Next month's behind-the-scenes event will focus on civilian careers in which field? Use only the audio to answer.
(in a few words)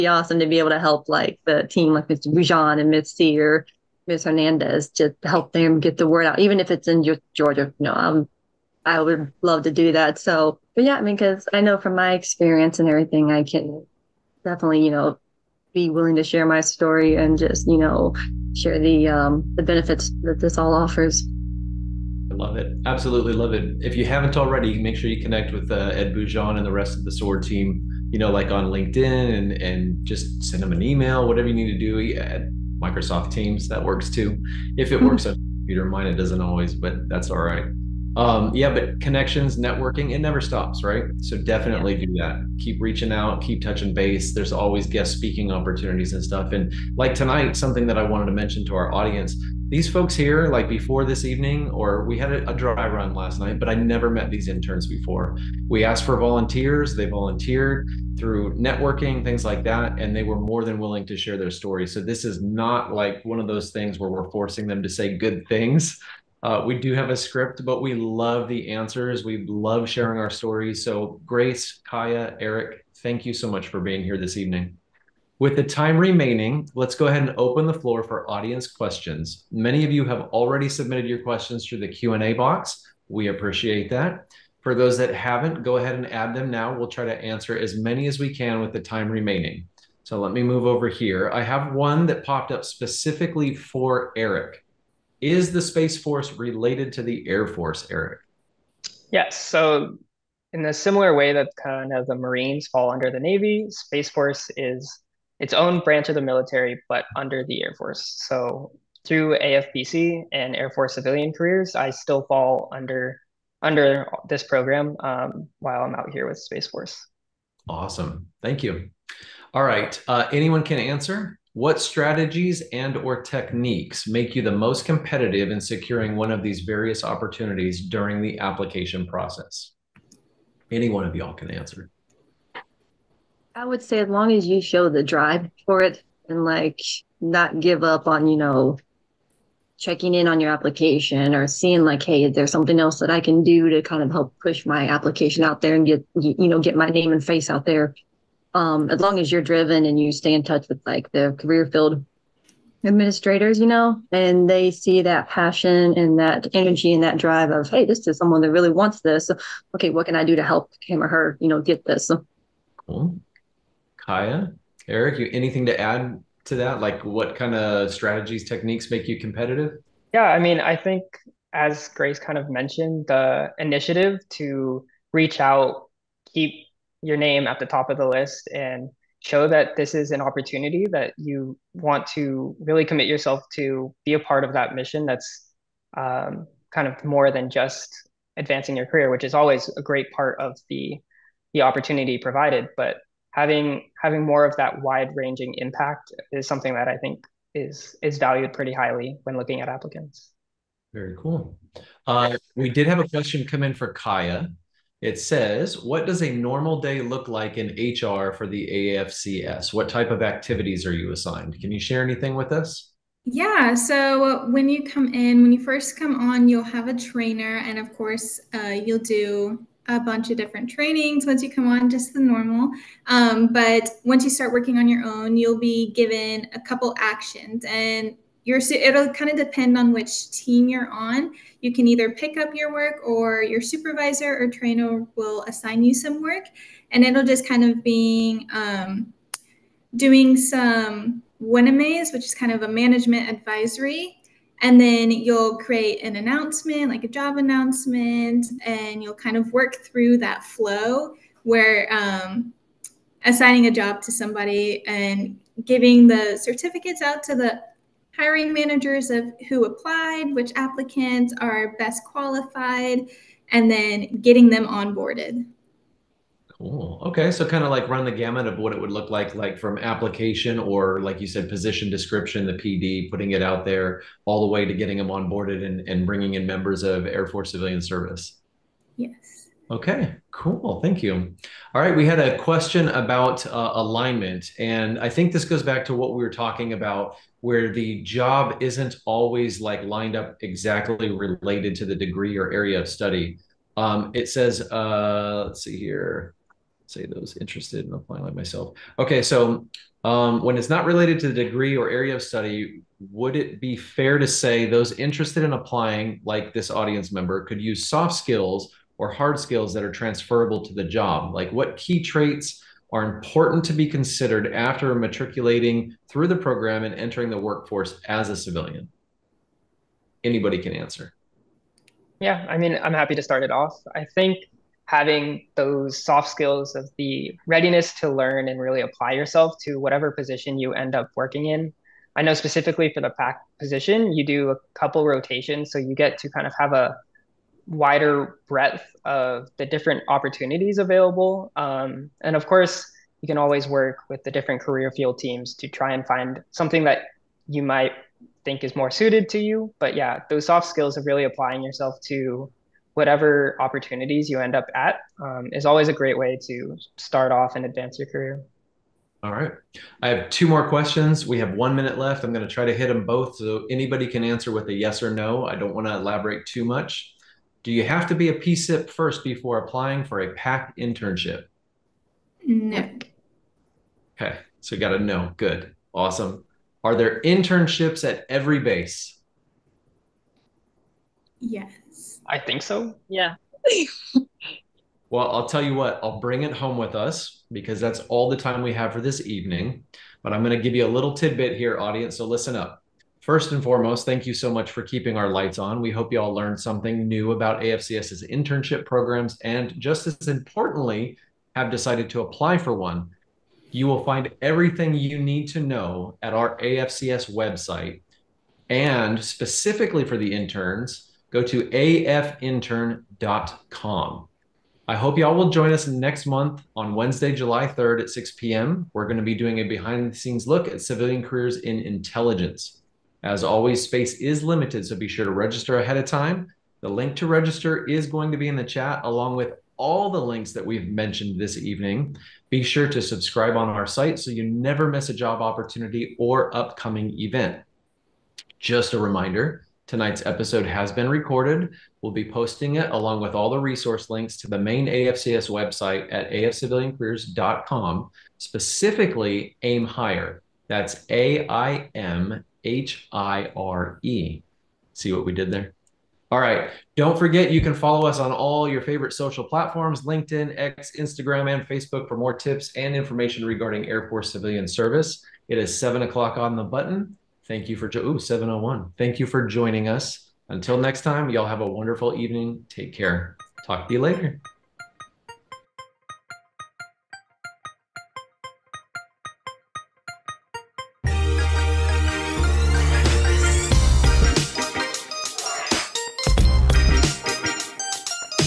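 Intelligence.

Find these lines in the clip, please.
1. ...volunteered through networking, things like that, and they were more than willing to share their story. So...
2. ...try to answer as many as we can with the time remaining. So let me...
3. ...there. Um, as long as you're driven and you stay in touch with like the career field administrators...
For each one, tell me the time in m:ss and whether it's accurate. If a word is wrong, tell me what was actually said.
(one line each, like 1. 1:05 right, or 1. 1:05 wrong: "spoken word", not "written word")
1. 0:57 right
2. 1:26 right
3. 2:27 right.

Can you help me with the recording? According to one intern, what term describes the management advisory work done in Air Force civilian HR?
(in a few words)
WinAmaze.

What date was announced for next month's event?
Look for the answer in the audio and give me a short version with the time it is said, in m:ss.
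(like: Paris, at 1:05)
Wednesday, July 3rd, at 6:56.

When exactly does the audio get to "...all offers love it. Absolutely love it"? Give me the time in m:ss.
0:20.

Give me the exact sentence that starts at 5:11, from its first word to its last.
Like what key traits are important to be considered after matriculating through the program and entering the workforce as a civilian?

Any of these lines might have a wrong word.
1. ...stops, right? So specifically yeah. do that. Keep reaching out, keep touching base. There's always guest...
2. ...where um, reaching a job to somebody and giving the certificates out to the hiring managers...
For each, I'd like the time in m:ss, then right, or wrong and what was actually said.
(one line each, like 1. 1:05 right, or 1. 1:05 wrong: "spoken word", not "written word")
1. 0:40 wrong: "definitely", not "specifically"
2. 4:11 wrong: "assigning", not "reaching".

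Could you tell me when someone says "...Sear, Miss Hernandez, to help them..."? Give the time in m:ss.
0:03.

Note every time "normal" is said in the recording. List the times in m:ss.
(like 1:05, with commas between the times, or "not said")
3:26, 3:42.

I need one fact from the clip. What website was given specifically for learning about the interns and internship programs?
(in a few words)
afintern.com.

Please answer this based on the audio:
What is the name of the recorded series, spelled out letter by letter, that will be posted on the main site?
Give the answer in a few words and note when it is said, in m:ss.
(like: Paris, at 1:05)
Aim Hire, at 7:29.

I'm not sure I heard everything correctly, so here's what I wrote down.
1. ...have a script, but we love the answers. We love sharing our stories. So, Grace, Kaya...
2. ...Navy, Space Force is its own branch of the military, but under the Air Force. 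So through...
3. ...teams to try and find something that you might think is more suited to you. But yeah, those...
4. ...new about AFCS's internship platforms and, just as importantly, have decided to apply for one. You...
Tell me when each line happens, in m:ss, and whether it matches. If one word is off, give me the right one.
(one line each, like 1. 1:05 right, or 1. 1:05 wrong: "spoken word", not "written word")
1. 1:06 right
2. 1:43 right
3. 5:45 right
4. 6:37 wrong: "programs", not "platforms".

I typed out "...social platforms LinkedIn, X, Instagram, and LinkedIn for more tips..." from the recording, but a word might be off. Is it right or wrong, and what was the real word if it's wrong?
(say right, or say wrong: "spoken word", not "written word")
wrong: "Facebook", not "LinkedIn".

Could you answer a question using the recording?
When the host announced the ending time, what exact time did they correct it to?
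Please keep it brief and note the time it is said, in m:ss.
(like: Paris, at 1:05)
7:01, at 7:48.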